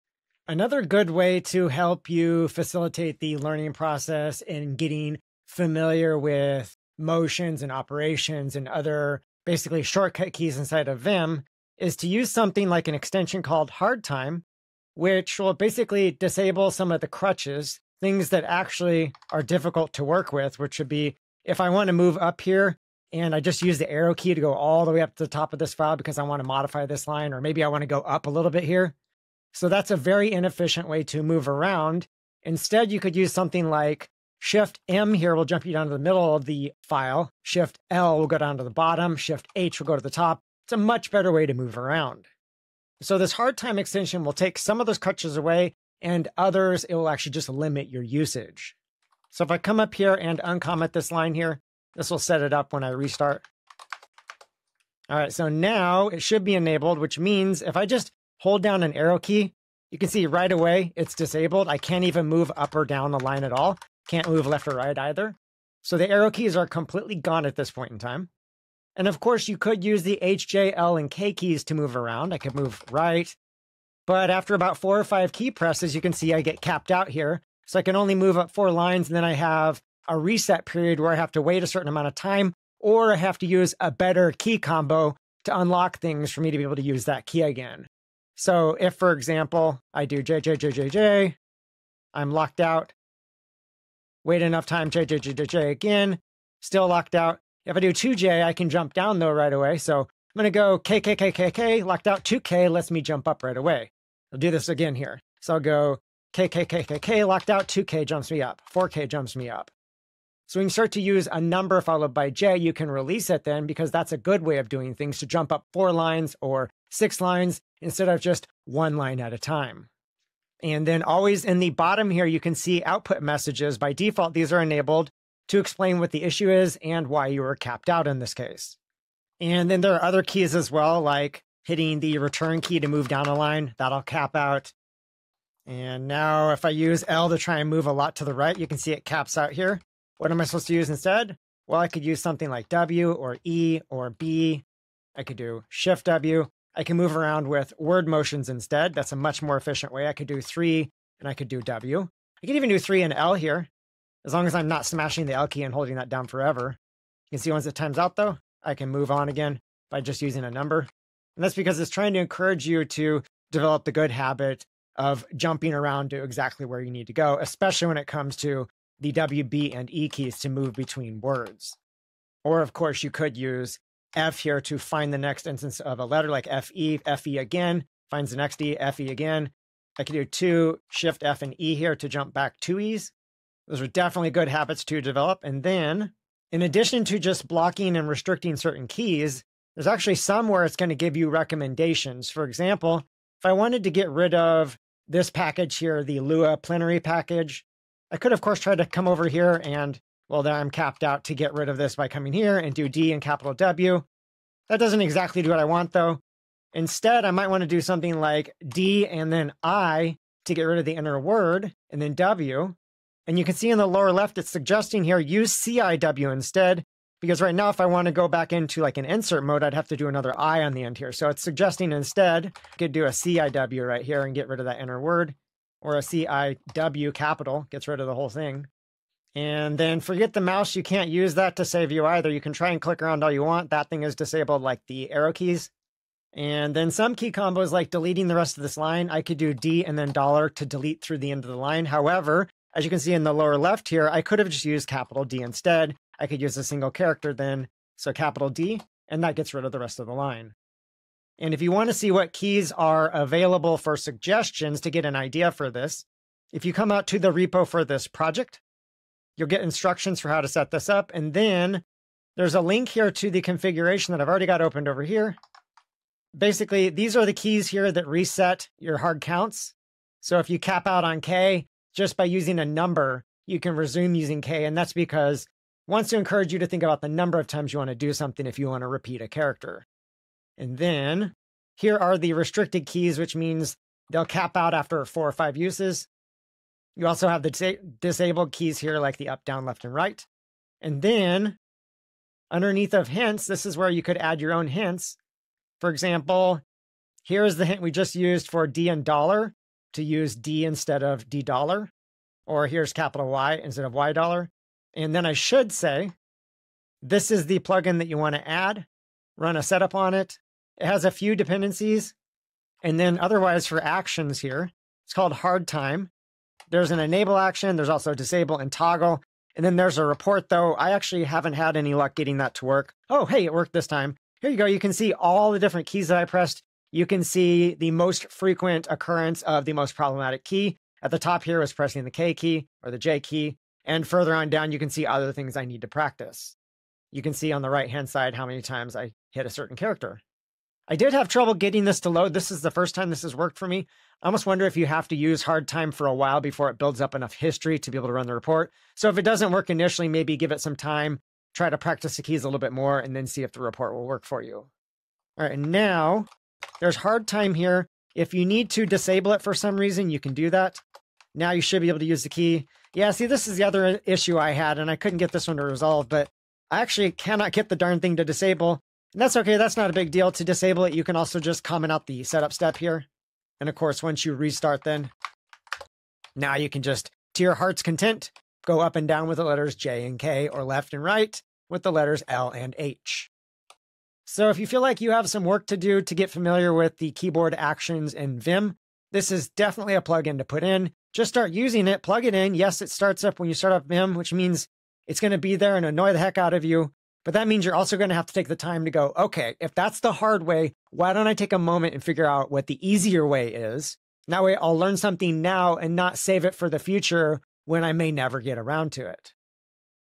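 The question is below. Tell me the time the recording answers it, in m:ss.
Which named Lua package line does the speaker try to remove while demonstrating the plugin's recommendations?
3:16.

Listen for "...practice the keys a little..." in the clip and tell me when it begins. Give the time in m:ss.
5:51.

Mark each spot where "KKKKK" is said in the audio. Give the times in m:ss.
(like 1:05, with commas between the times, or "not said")
1:40, 1:46.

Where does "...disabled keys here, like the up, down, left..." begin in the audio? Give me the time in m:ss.
4:47.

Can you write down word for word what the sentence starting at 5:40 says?
I did have trouble getting this to load.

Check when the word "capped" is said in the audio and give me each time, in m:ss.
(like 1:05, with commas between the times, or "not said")
1:16, 2:07, 3:20.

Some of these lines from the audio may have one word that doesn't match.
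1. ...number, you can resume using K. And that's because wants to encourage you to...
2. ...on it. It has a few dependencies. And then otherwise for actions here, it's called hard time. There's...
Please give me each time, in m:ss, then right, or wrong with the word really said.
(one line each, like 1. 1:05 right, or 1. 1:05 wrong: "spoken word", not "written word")
1. 4:32 right
2. 5:09 right.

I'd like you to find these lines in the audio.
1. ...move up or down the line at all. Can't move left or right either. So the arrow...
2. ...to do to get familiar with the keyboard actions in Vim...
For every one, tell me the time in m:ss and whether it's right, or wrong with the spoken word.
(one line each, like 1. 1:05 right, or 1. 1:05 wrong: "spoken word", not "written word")
1. 1:02 right
2. 6:25 right.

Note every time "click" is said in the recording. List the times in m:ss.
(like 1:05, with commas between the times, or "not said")
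3:52.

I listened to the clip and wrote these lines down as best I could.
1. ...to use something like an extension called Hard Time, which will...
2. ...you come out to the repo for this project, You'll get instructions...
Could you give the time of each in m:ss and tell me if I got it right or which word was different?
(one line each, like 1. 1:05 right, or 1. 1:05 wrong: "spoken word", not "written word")
1. 0:11 right
2. 4:16 right.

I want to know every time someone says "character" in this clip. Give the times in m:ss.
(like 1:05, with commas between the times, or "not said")
4:06, 4:39, 5:39.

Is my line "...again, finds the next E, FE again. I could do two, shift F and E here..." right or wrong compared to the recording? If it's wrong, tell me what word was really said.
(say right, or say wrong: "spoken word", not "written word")
right.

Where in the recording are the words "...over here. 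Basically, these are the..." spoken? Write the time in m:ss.
4:24.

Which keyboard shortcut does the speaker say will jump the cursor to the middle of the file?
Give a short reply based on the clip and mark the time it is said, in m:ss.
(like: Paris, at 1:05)
Shift M, at 0:34.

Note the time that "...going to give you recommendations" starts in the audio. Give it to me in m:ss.
3:10.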